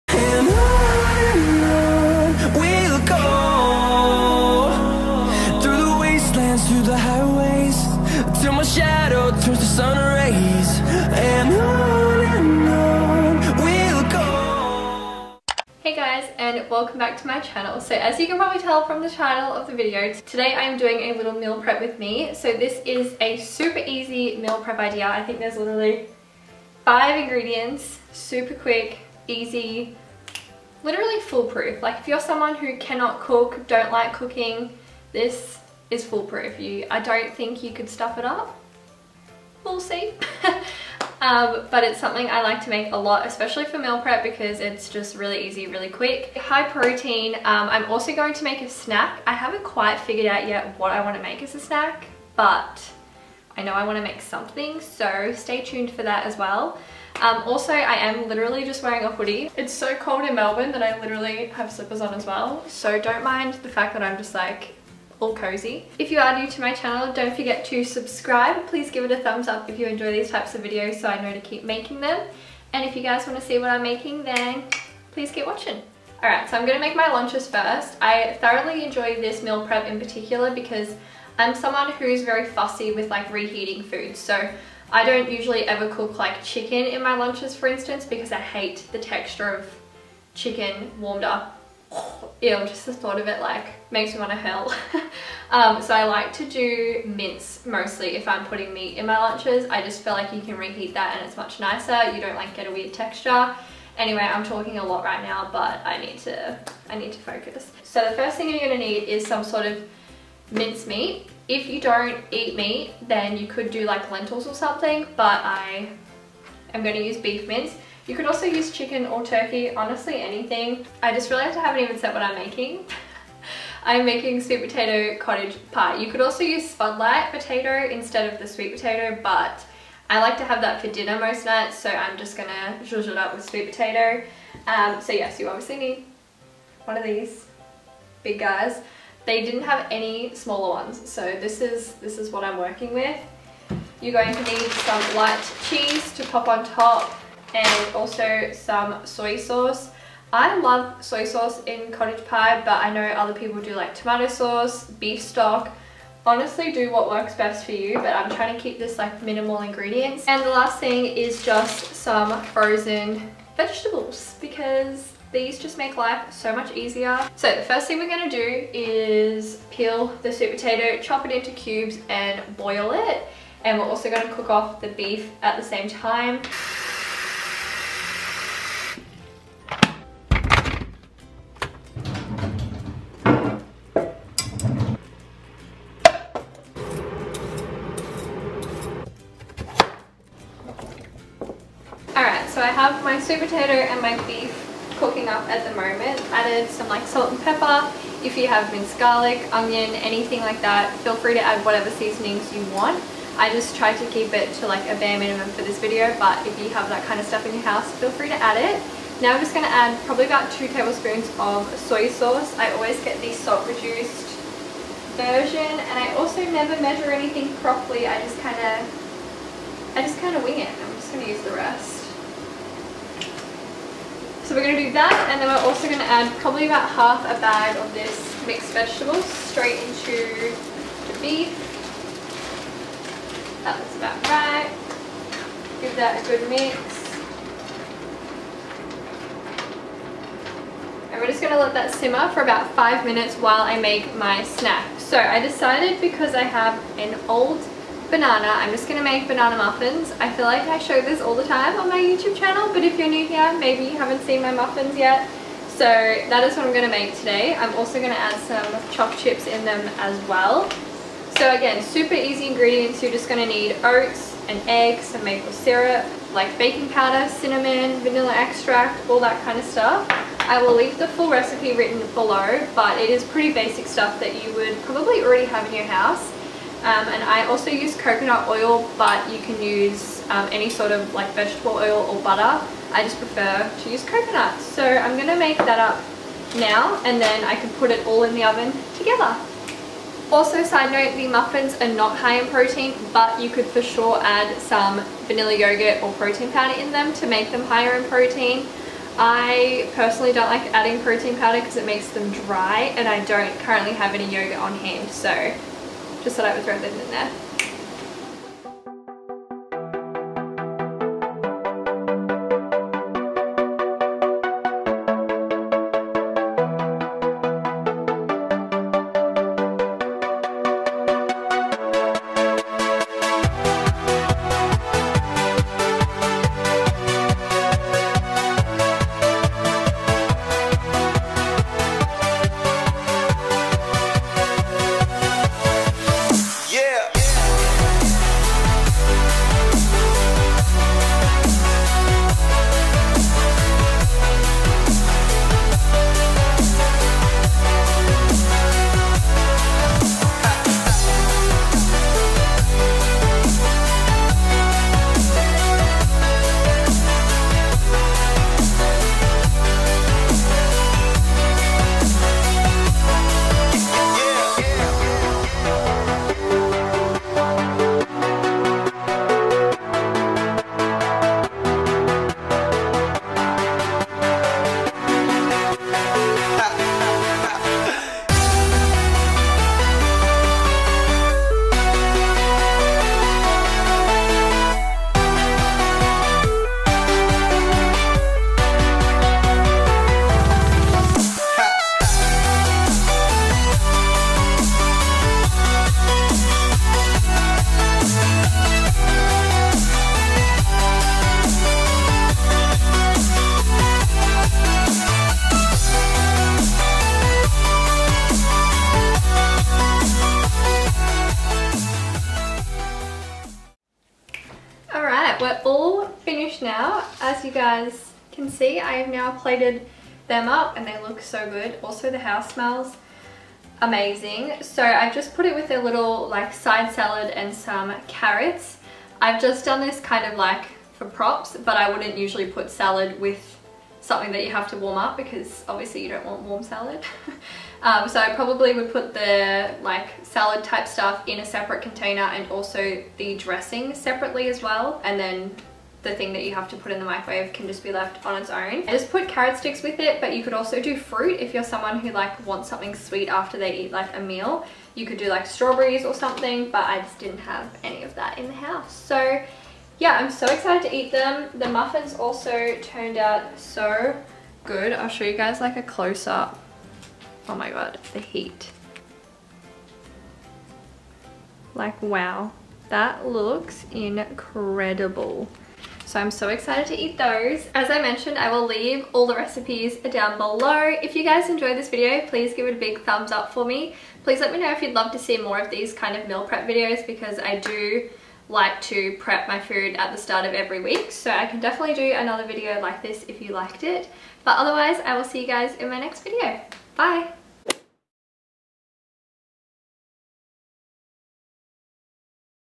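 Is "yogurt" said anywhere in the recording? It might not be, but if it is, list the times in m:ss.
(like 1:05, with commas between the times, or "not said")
4:55, 5:04.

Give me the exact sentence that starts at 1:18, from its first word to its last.
I thoroughly enjoy this meal prep in particular because I'm someone who's very fussy with like reheating food.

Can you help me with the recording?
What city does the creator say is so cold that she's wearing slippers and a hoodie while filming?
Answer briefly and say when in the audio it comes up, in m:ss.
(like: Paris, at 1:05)
Melbourne, at 1:00.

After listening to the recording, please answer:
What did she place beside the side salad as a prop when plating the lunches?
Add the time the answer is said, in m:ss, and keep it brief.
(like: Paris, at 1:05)
Carrots, at 7:08.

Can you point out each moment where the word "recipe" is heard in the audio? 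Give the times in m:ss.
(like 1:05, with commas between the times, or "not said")
4:31, 7:59.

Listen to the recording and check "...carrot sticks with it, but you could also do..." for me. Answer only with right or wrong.
right.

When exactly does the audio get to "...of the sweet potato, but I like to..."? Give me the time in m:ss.
2:08.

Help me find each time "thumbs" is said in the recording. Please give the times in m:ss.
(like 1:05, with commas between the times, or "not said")
1:09, 8:03.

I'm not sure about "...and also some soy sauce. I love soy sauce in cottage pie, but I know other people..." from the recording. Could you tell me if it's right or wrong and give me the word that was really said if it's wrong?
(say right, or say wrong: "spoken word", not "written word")
right.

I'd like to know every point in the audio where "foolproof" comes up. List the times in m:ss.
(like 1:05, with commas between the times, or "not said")
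0:31, 0:36.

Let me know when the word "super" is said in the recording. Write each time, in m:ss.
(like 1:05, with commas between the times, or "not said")
0:23, 0:28, 4:21.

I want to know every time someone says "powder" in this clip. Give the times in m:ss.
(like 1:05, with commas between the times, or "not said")
4:26, 4:56, 5:01.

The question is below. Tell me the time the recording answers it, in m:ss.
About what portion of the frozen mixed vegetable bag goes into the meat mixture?
3:46.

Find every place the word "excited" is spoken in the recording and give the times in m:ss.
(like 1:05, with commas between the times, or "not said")
7:40, 7:56.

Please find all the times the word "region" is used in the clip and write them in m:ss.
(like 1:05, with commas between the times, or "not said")
not said.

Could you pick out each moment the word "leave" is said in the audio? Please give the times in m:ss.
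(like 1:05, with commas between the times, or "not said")
4:30, 7:58.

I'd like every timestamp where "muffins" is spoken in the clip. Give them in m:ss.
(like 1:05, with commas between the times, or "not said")
4:09, 4:14, 4:51, 7:41.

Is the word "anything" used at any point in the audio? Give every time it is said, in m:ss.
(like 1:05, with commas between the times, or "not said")
2:00, 3:19, 3:37.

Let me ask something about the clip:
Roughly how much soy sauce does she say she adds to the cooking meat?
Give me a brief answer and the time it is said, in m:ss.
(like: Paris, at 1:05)
2 tablespoons, at 3:30.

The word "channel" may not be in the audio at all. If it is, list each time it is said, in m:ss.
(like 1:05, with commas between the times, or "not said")
0:17, 1:06, 4:12.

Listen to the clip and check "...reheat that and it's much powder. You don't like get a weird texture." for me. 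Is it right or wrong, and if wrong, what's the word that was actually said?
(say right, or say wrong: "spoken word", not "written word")
wrong: "nicer", not "powder".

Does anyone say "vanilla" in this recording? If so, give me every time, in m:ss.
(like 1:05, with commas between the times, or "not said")
4:28, 4:55.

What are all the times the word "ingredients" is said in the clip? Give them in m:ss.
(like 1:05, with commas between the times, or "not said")
0:27, 2:39, 4:22.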